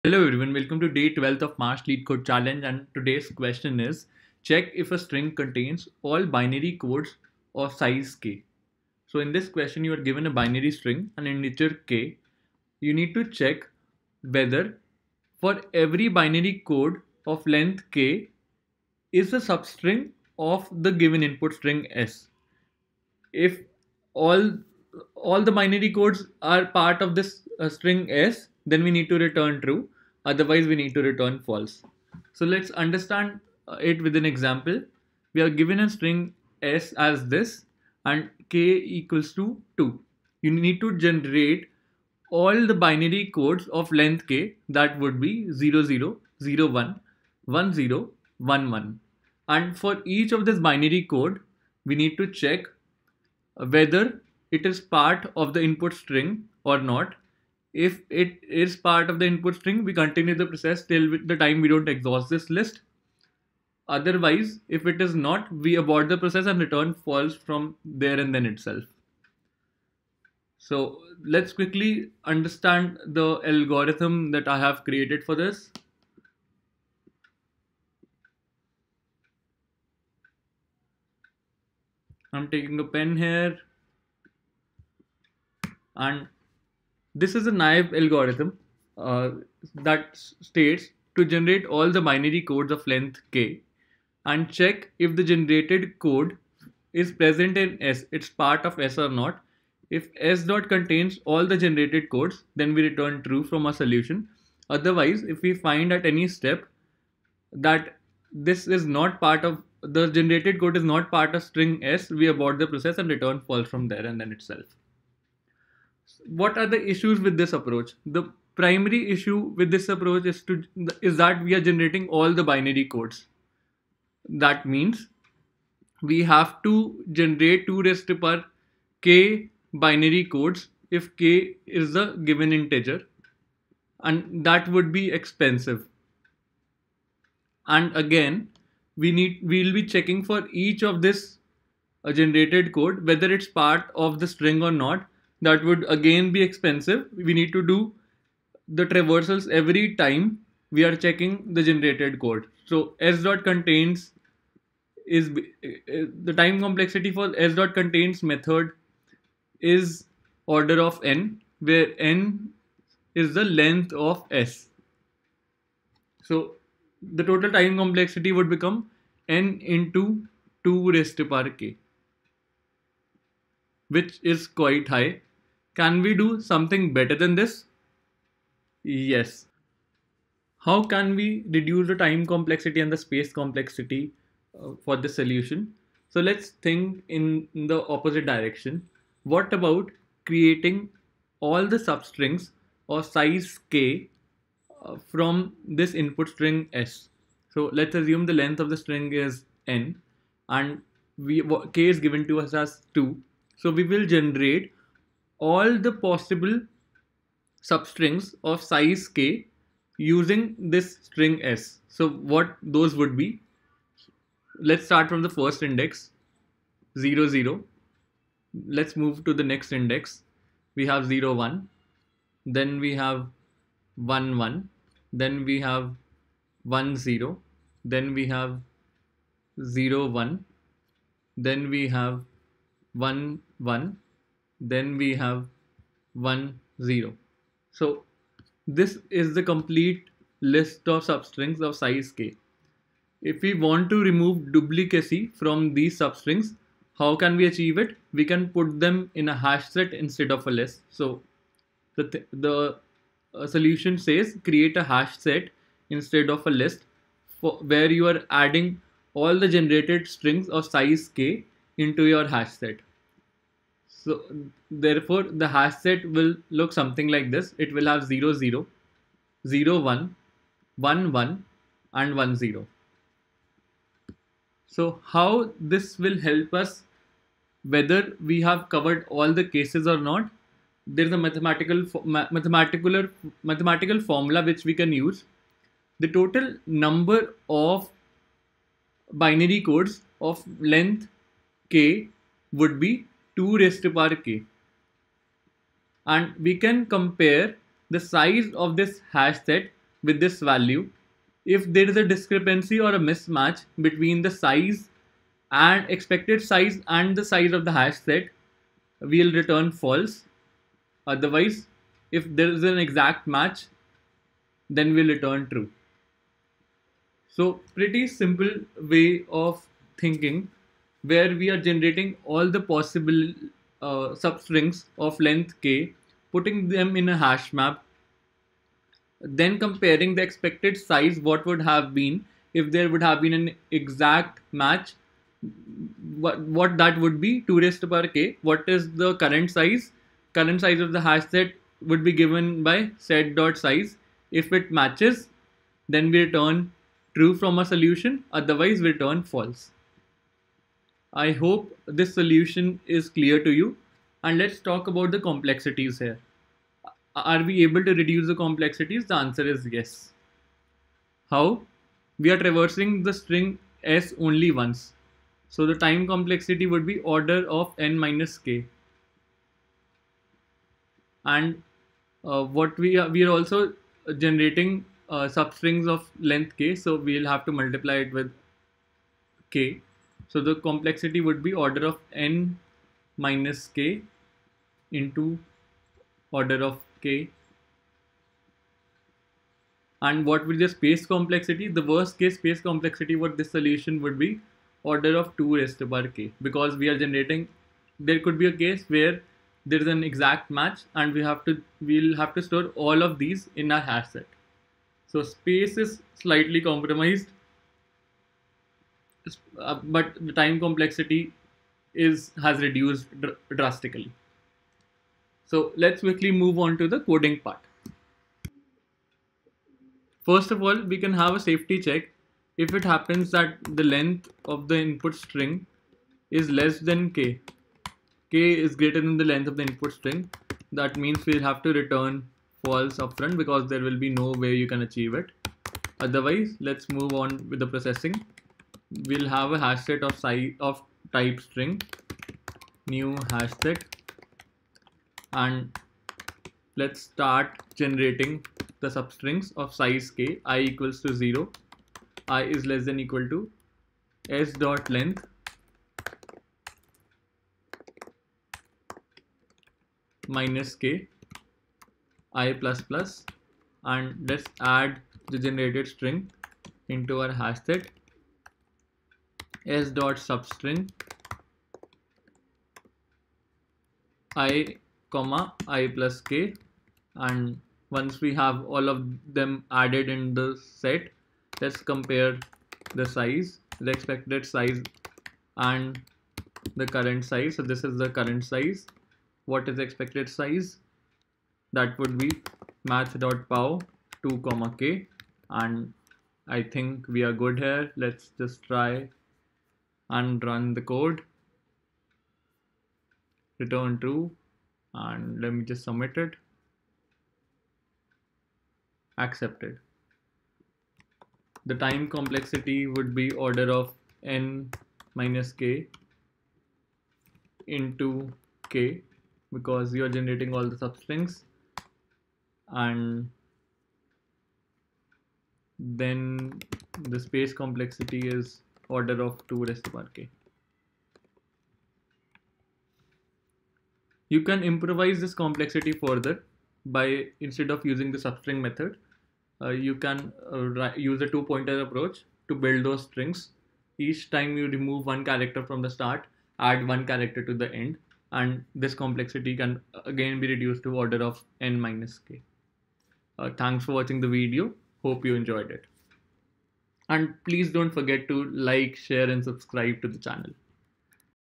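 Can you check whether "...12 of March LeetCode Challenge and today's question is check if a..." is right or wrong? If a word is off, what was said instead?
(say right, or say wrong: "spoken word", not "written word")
right.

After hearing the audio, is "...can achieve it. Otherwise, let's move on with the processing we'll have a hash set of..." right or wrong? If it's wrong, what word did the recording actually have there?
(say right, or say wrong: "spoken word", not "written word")
right.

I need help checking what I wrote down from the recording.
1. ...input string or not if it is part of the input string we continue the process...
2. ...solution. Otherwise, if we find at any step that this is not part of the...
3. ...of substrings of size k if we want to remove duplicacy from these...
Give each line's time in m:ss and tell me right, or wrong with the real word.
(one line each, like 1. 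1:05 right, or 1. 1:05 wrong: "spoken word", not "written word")
1. 0:55 right
2. 1:43 right
3. 4:00 right.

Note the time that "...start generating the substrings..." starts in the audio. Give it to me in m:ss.
7:27.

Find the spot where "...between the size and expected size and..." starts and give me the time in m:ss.
5:03.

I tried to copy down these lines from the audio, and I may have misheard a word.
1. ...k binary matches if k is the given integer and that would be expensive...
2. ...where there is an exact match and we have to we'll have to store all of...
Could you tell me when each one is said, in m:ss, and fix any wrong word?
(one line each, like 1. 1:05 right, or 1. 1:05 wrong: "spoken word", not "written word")
1. 2:09 wrong: "codes", not "matches"
2. 6:38 right.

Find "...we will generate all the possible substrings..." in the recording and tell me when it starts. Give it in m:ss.
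3:23.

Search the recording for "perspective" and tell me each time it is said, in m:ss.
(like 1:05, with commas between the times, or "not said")
not said.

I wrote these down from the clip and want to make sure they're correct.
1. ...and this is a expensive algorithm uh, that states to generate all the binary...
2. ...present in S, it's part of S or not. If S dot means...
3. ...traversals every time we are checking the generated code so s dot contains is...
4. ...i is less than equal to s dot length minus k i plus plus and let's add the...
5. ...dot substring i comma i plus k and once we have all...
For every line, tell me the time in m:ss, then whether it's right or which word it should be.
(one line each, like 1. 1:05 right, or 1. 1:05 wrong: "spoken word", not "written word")
1. 1:25 wrong: "naive", not "expensive"
2. 1:37 wrong: "contains", not "means"
3. 2:28 right
4. 7:32 right
5. 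7:49 right.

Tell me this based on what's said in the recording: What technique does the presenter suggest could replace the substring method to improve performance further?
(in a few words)
two pointer approach.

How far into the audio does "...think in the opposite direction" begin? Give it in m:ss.
3:06.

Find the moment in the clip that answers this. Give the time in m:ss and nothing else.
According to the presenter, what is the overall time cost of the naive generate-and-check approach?
2:49.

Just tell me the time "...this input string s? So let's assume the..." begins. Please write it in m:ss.
3:15.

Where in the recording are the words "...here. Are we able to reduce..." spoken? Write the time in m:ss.
5:55.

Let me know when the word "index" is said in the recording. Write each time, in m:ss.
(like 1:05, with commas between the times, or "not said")
3:35, 3:39.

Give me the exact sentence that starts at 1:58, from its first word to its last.
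The primary issue with this approach is to is that we are generating all the binary codes.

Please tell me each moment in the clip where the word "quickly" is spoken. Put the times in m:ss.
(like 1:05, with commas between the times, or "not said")
1:11, 6:56.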